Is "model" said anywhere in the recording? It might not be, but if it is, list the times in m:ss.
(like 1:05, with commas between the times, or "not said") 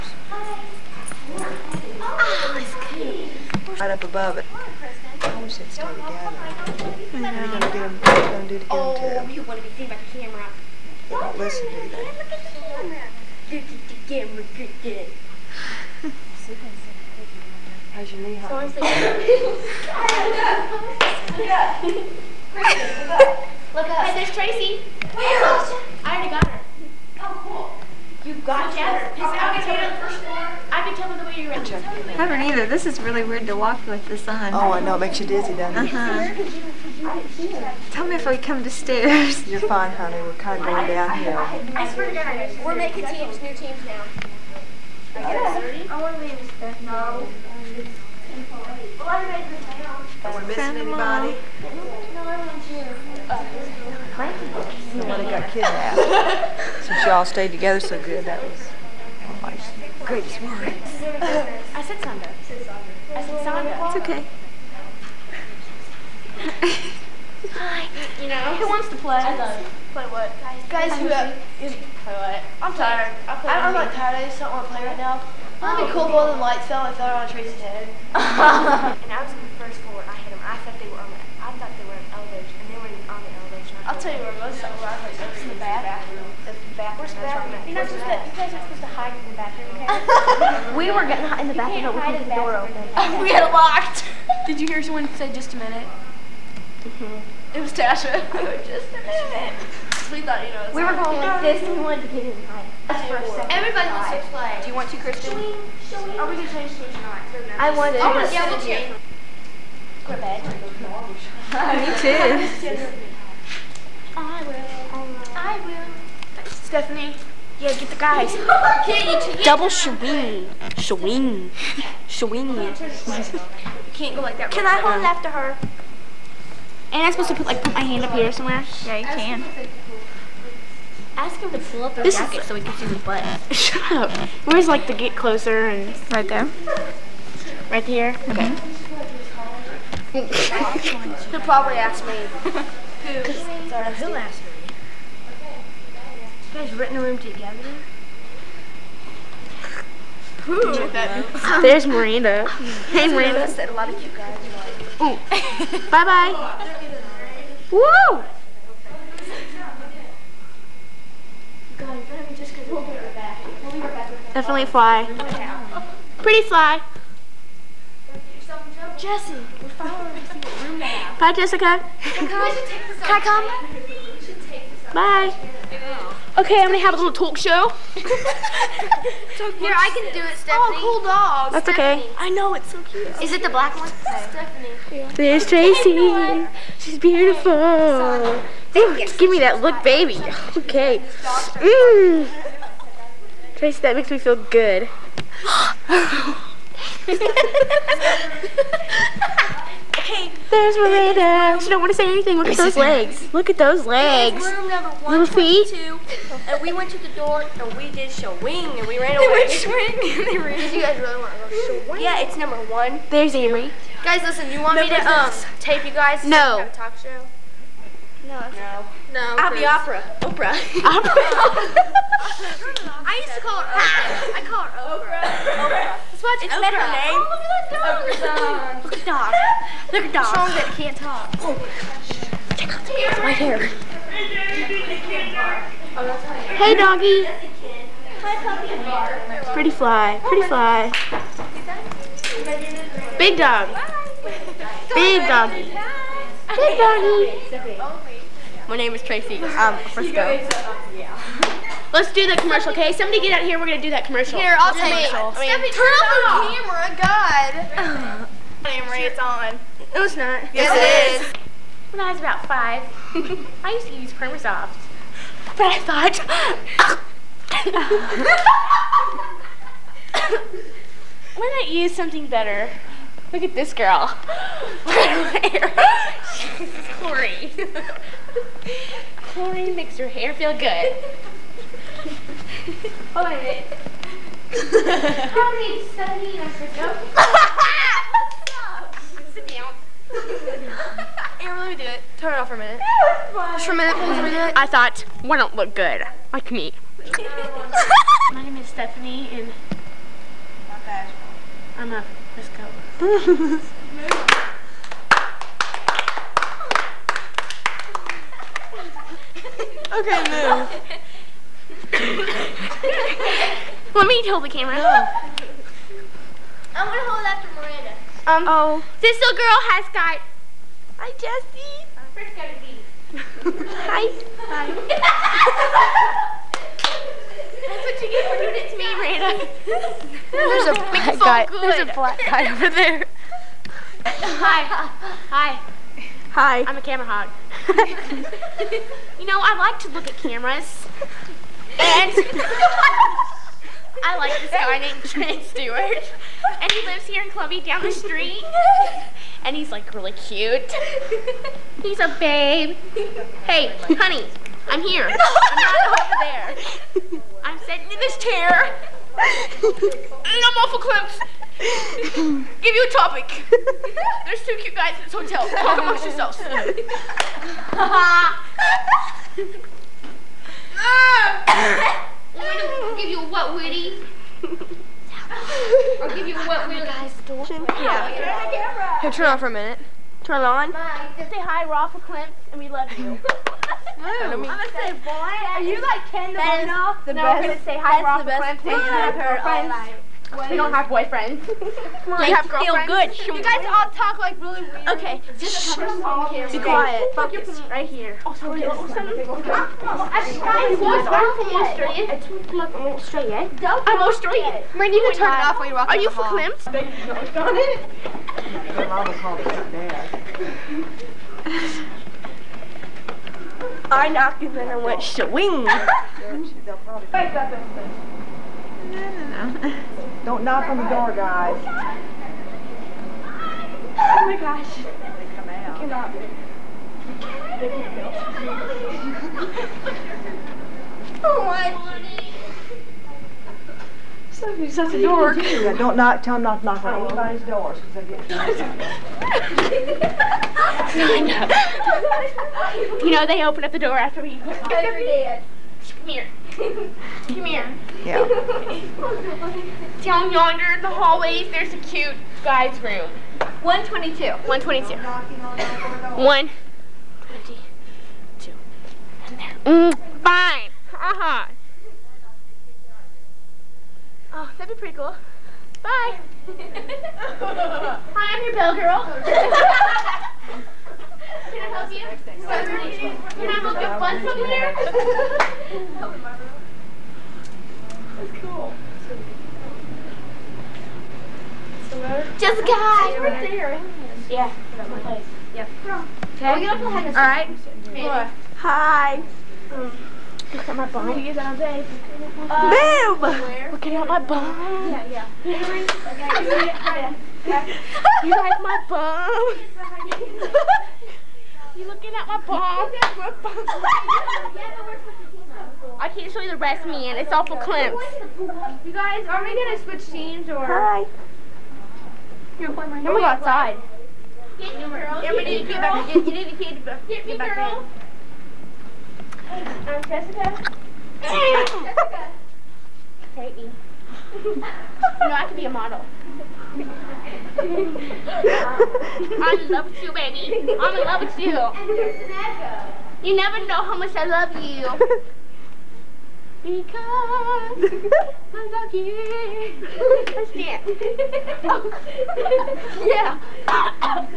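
8:45.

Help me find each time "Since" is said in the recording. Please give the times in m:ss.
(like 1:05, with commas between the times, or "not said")
0:56.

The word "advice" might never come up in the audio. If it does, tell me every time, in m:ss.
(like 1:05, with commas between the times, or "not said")
not said.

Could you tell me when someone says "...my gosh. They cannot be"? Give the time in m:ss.
7:04.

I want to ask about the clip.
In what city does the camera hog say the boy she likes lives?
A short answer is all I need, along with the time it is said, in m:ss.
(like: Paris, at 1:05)
Columbia, at 5:47.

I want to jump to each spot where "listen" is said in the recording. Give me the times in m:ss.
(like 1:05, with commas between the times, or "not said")
0:11, 3:34.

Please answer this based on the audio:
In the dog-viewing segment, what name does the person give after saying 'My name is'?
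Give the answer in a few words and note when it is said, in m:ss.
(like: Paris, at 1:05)
Frisco, at 4:09.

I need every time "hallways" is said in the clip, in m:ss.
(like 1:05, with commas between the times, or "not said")
7:30.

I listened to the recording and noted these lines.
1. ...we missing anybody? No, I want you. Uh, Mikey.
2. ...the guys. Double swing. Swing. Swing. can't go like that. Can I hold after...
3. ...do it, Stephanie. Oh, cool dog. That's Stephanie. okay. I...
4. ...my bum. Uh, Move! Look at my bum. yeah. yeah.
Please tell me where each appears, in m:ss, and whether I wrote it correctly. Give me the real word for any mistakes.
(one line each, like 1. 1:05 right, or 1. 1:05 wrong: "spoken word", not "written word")
1. 0:50 right
2. 1:57 right
3. 3:00 right
4. 8:10 right.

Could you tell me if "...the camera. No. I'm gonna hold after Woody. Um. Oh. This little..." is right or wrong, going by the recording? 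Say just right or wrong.
wrong.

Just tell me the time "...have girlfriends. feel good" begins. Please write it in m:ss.
6:32.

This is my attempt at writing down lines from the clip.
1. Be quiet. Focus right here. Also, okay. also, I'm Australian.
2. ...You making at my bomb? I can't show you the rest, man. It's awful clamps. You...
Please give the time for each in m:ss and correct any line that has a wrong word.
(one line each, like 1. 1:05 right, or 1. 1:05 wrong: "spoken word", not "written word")
1. 6:36 right
2. 8:21 wrong: "looking", not "making".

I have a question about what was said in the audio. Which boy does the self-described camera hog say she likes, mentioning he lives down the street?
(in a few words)
Trey Stewart.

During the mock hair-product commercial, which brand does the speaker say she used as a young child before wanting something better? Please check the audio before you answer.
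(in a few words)
Permasoft.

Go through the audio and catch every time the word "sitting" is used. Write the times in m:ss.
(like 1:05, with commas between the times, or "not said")
5:57.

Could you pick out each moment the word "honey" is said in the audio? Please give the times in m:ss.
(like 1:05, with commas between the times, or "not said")
0:39, 5:53.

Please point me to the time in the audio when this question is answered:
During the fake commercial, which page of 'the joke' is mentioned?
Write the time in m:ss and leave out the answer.
4:45.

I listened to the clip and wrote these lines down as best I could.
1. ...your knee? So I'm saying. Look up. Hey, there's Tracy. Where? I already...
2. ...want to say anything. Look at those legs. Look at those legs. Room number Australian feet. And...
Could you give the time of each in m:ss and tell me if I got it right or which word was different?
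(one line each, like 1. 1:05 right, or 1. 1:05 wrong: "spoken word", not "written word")
1. 0:18 right
2. 3:21 wrong: "Little", not "Australian".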